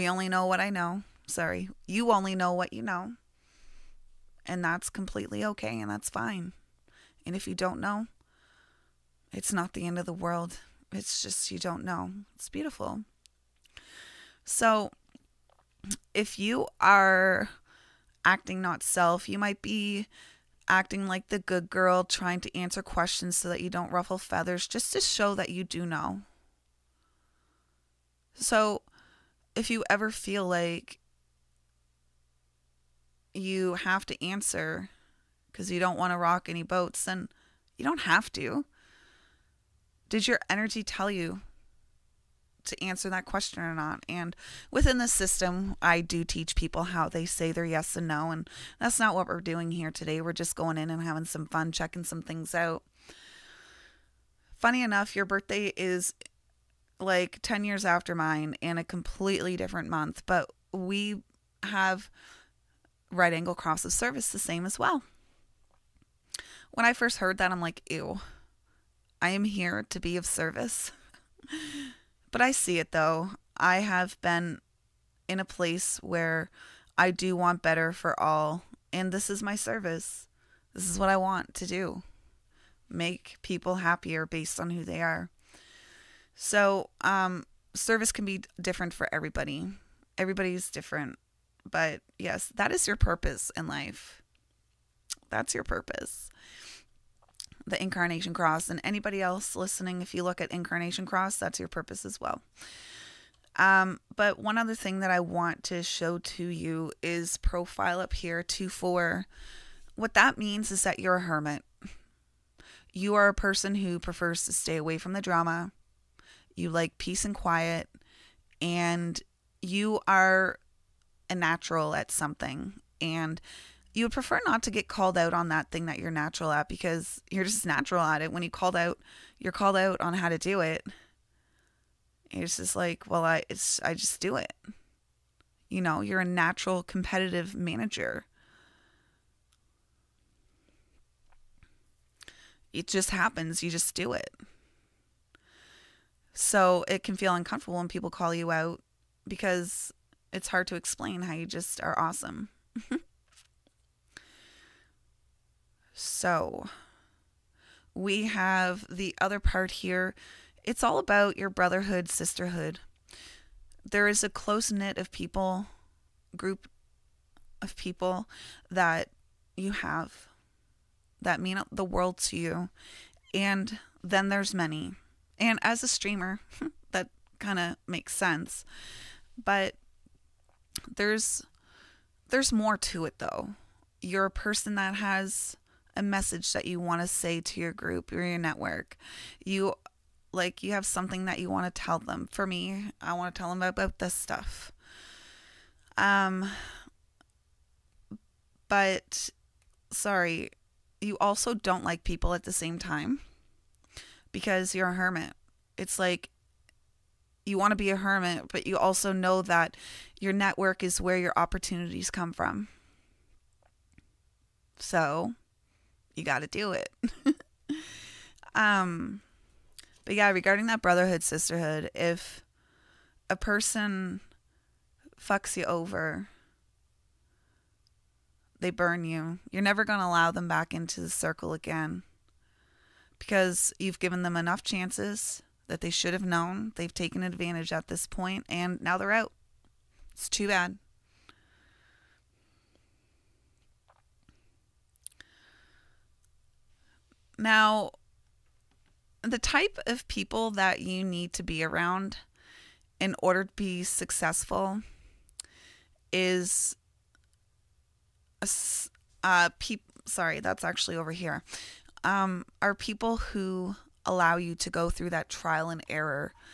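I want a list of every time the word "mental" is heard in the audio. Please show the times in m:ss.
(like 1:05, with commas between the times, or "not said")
not said.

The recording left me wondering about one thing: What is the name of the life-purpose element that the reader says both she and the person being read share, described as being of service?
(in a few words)
Right angle cross of service.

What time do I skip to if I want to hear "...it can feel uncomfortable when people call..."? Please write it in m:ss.
2:26.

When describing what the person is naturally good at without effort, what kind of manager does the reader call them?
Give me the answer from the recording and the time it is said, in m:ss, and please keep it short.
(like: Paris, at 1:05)
Competitive manager, at 2:16.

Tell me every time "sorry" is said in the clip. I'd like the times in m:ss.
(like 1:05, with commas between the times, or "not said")
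0:01, 3:19, 4:20.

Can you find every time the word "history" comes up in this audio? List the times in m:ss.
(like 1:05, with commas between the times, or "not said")
not said.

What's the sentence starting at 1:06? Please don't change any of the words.
When I first heard that, I'm like, ew, I am here to be of service.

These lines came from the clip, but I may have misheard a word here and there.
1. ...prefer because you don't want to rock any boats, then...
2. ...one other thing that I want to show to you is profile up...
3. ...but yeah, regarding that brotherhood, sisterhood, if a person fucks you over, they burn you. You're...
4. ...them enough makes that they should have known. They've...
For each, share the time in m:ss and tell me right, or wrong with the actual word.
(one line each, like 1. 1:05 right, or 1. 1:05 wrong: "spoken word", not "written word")
1. 0:34 wrong: "answer", not "prefer"
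2. 1:44 right
3. 3:40 right
4. 3:54 wrong: "chances", not "makes".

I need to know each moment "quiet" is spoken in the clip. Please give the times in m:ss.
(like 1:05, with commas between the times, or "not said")
1:57.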